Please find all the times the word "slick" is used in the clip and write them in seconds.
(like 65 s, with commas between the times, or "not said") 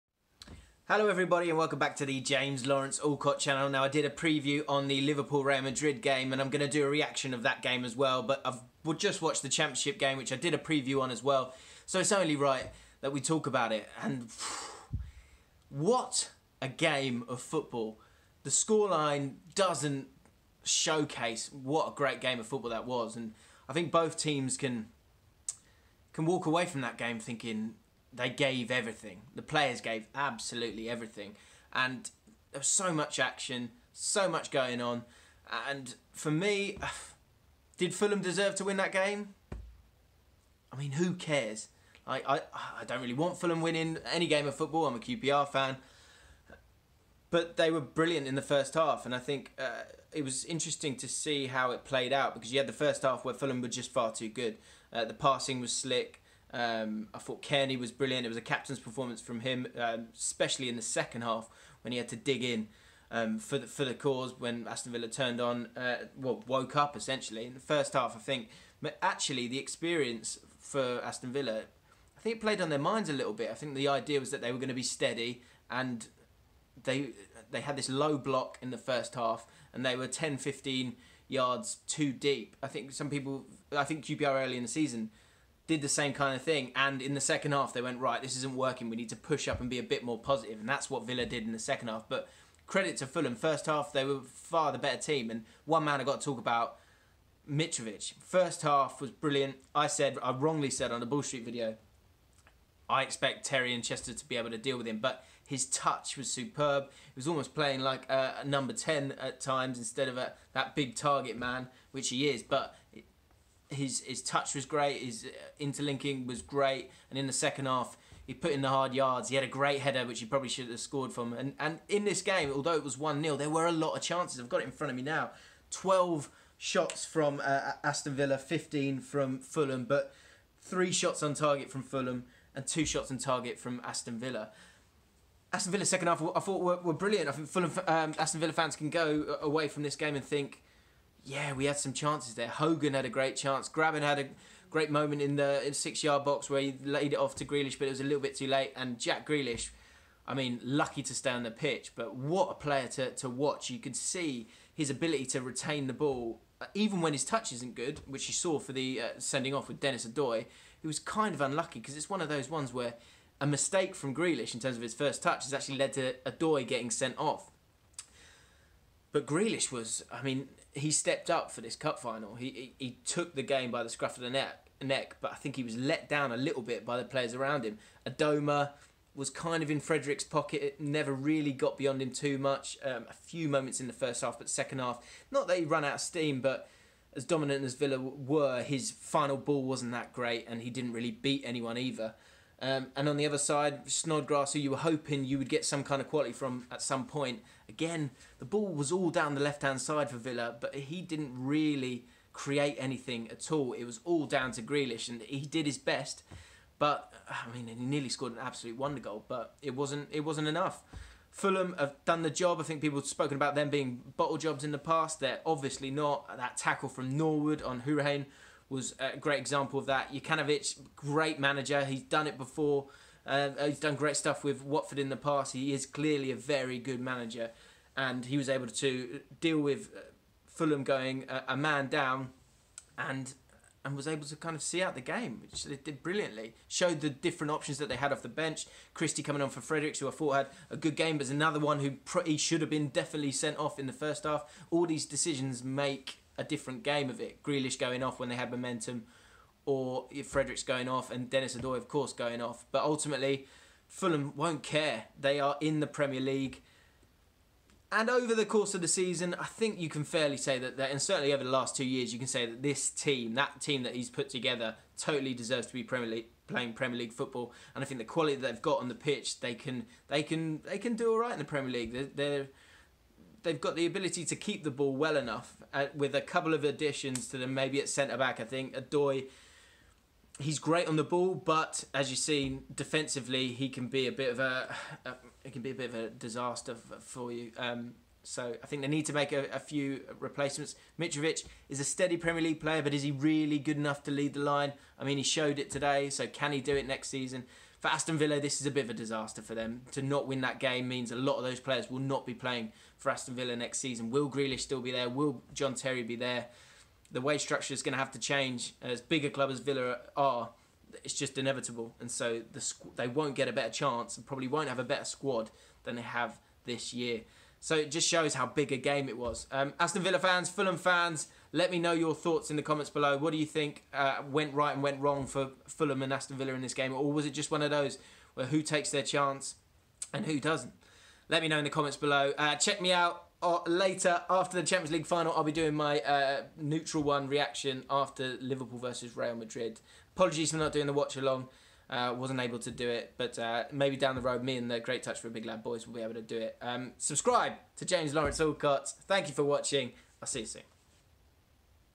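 55 s.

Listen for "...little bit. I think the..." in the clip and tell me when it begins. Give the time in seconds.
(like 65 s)
73 s.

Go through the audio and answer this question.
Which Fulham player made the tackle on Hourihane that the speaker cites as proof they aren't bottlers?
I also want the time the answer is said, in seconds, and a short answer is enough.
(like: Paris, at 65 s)
Norwood, at 217 s.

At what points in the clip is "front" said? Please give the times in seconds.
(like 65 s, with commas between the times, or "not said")
124 s.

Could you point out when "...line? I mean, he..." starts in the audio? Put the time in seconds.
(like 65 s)
294 s.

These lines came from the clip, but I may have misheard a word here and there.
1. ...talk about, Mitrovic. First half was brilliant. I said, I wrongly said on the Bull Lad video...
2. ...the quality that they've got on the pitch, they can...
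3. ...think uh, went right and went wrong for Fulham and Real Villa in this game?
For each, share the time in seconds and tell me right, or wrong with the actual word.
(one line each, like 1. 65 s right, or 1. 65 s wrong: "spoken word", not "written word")
1. 96 s wrong: "Street", not "Lad"
2. 267 s right
3. 323 s wrong: "Aston", not "Real".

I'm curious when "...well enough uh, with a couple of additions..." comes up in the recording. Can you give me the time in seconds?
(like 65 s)
274 s.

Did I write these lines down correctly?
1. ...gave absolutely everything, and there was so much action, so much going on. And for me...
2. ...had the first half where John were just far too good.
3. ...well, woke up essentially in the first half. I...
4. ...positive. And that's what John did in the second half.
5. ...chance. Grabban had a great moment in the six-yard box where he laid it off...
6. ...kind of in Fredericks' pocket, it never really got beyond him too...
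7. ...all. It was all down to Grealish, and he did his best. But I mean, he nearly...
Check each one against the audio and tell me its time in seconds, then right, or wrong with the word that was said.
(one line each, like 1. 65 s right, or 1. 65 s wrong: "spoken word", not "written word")
1. 29 s right
2. 52 s wrong: "Fulham", not "John"
3. 66 s right
4. 90 s wrong: "Villa", not "John"
5. 143 s right
6. 179 s right
7. 203 s right.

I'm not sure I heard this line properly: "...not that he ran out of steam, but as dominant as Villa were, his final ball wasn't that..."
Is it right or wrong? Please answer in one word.
right.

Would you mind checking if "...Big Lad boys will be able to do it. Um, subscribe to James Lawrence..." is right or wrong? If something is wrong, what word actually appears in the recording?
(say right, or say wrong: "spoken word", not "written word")
right.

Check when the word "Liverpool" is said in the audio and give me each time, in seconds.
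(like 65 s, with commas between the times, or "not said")
4 s, 338 s.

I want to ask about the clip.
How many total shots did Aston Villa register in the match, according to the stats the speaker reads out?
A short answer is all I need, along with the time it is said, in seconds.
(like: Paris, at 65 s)
12, at 125 s.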